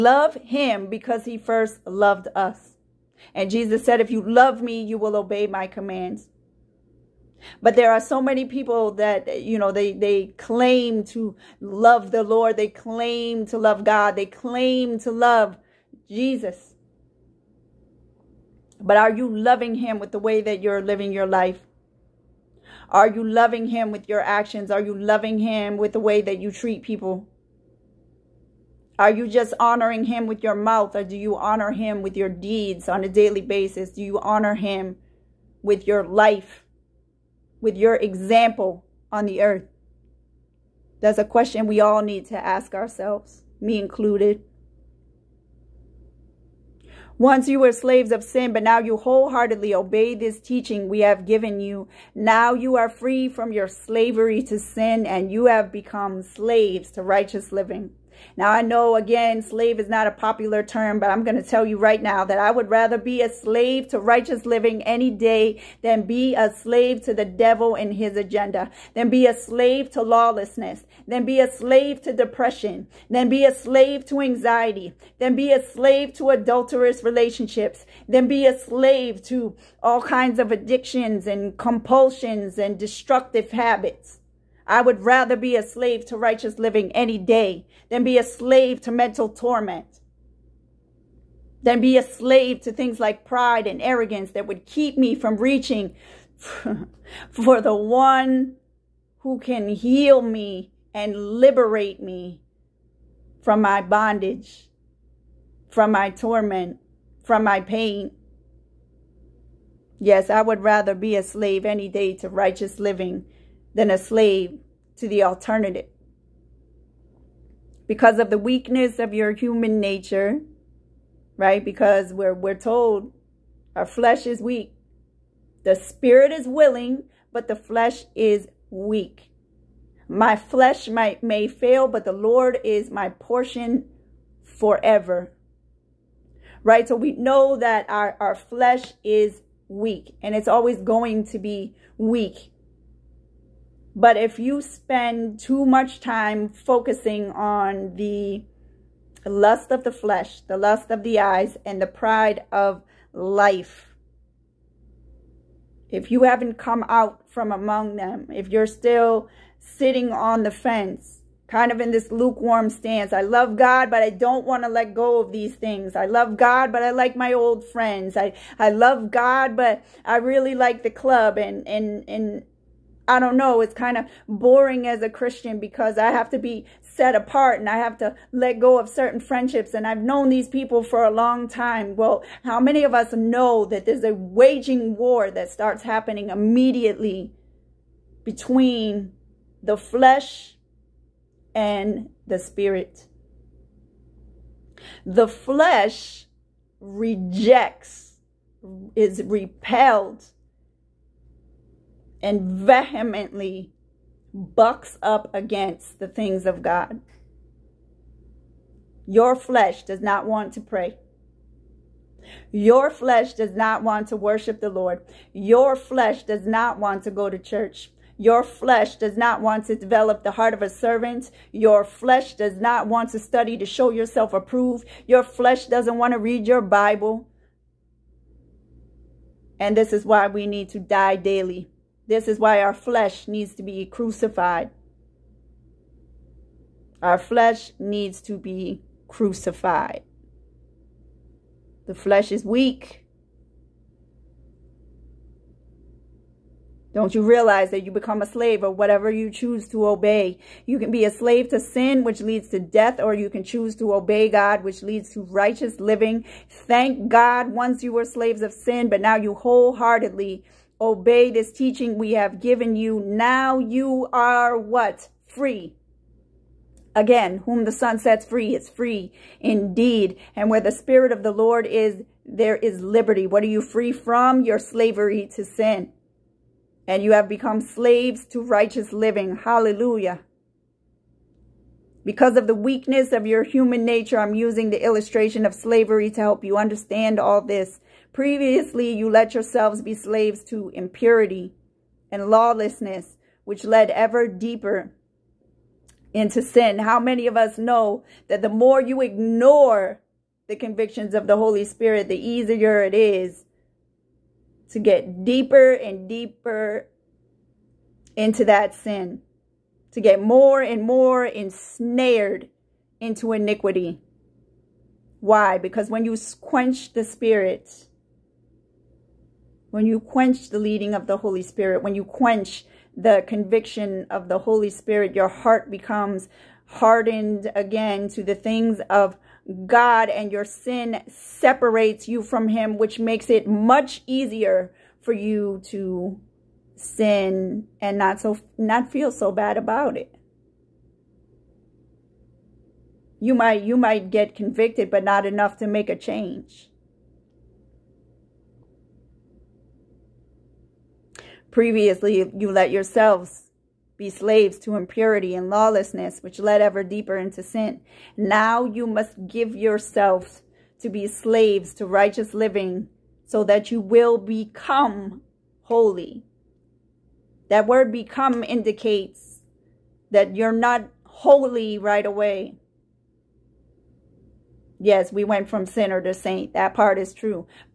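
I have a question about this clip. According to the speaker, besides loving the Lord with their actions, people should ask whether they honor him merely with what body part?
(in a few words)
mouth.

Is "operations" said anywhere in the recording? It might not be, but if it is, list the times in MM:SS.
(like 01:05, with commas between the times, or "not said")
not said.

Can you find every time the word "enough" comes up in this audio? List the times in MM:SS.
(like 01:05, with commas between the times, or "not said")
05:45.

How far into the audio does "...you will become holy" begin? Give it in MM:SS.
06:03.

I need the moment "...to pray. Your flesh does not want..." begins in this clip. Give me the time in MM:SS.
03:30.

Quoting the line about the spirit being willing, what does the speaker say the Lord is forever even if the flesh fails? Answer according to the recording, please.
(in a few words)
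my portion.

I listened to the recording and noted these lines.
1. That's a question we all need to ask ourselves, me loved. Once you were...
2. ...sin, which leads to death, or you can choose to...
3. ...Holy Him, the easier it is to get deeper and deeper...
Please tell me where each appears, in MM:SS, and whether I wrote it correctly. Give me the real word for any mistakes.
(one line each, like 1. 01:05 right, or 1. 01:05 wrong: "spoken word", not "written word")
1. 00:40 wrong: "included", not "loved"
2. 04:11 right
3. 05:01 wrong: "Spirit", not "Him".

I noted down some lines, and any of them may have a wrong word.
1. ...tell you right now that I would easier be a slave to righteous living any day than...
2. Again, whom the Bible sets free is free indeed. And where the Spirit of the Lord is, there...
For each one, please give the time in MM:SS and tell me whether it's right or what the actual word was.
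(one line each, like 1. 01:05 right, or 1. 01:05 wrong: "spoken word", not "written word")
1. 01:01 wrong: "rather", not "easier"
2. 04:26 wrong: "Son", not "Bible".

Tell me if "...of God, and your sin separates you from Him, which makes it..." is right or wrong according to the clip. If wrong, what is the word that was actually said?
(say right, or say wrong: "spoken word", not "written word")
right.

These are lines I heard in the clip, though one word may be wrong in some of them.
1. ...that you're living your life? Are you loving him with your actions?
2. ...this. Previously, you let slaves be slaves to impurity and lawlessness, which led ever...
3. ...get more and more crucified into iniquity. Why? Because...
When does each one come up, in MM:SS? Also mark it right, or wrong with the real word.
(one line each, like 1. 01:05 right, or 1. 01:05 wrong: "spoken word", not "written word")
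1. 00:20 right
2. 04:47 wrong: "yourselves", not "slaves"
3. 05:10 wrong: "ensnared", not "crucified".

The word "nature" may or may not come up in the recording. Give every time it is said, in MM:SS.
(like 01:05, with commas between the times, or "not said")
01:59, 04:43.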